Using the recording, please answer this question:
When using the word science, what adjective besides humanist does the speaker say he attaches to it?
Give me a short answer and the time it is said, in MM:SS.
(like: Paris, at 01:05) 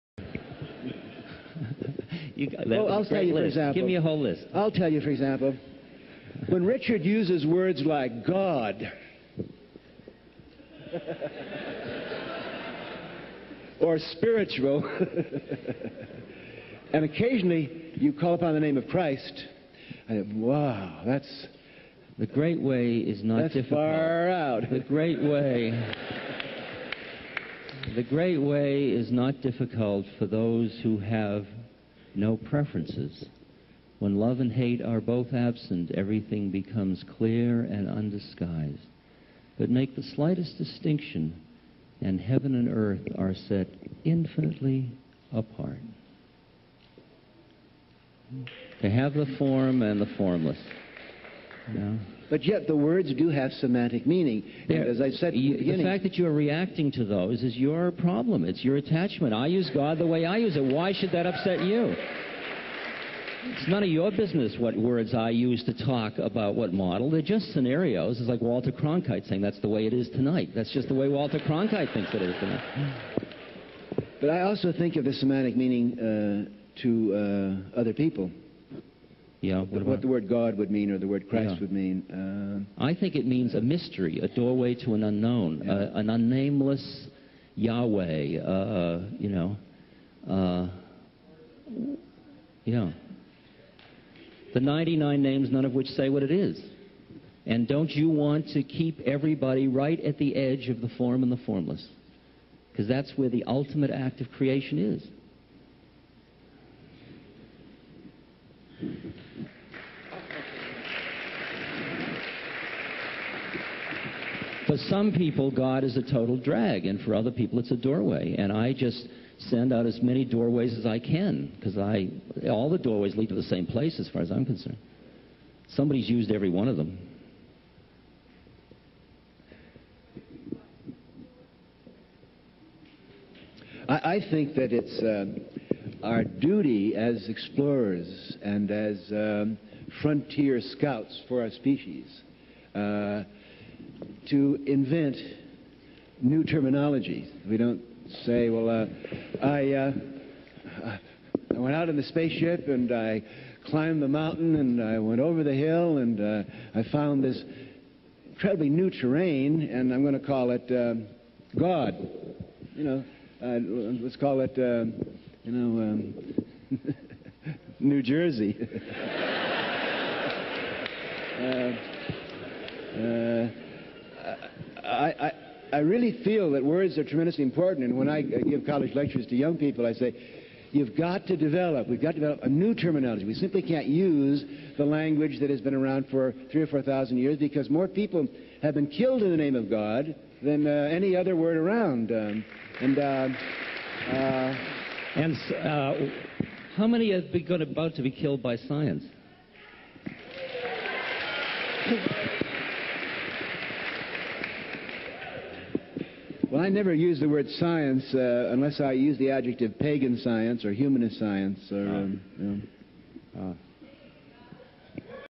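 pagan, at 03:29.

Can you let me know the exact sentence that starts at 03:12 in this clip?
Um, and uh, uh, and uh, how many are about to be killed by science?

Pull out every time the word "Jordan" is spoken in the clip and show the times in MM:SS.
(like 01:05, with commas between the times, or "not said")
not said.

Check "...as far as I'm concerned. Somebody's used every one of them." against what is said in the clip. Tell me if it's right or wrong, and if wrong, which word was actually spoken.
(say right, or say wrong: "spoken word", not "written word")
right.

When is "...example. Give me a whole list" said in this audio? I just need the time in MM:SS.
00:03.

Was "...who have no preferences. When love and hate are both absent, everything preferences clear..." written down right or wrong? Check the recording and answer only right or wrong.
wrong.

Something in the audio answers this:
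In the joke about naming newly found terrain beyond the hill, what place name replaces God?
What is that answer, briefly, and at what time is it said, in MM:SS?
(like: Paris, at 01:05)
New Jersey, at 02:47.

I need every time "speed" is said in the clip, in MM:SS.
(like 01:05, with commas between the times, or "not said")
not said.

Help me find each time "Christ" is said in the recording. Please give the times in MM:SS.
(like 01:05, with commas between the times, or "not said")
00:18, 01:21.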